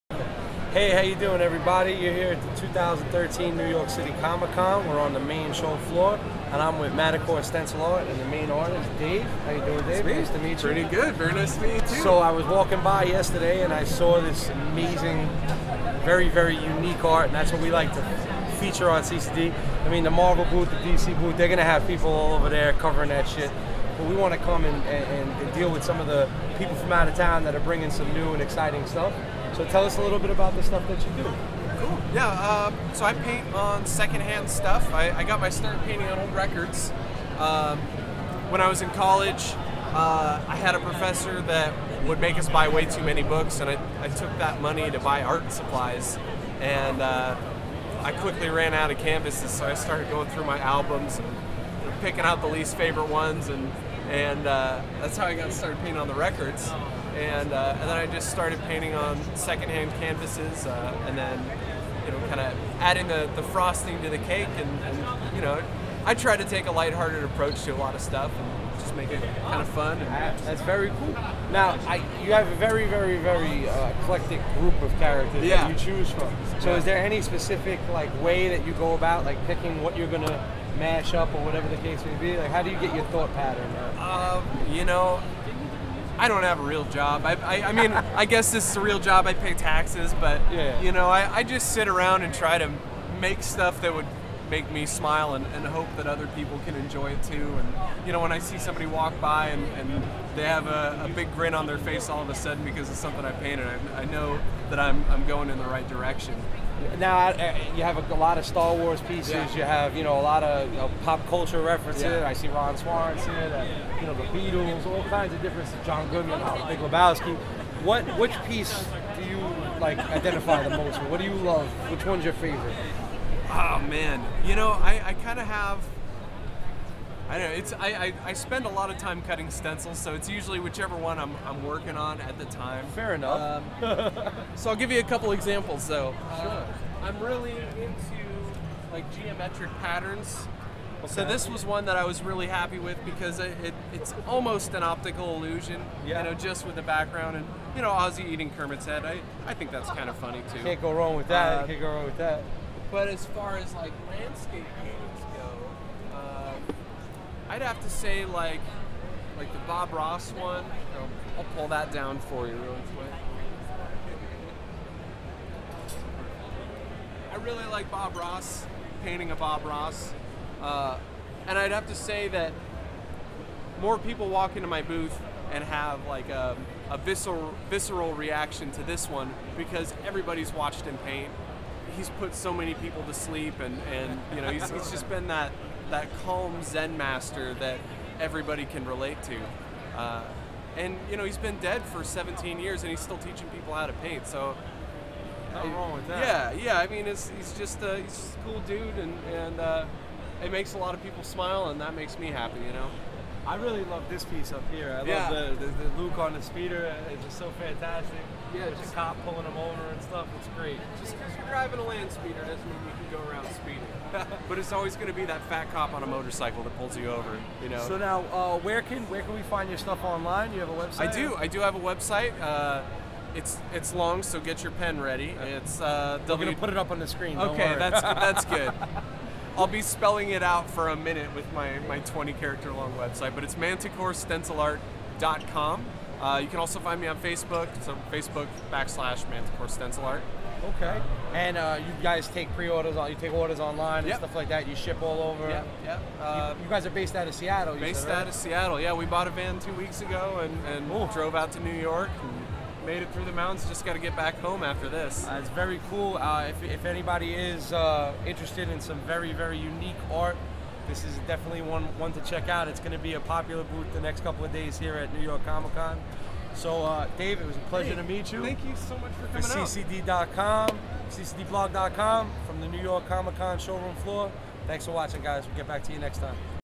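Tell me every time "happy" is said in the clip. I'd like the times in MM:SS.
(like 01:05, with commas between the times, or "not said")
02:22, 03:22.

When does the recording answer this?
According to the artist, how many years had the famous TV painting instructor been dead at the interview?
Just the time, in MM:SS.
03:12.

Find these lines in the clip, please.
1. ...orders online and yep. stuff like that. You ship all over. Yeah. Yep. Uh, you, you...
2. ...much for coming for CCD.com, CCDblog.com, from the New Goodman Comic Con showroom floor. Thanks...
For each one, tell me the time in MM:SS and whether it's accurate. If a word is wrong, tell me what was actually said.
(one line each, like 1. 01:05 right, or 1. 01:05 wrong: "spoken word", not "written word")
1. 04:03 right
2. 04:28 wrong: "York", not "Goodman".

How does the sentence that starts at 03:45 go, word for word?
It's uh, We're gonna put it up on the screen.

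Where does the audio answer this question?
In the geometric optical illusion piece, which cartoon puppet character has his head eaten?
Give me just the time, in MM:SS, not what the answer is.
02:28.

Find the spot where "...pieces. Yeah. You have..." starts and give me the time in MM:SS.
01:49.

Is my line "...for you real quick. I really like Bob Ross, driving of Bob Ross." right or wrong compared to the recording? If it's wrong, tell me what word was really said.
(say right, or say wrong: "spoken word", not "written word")
wrong: "painting", not "driving".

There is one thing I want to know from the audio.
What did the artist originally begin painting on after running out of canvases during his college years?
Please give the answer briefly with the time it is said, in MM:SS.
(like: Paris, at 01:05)
Old records, at 00:36.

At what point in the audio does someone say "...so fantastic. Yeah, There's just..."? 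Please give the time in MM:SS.
03:27.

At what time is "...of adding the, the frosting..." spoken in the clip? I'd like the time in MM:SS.
01:02.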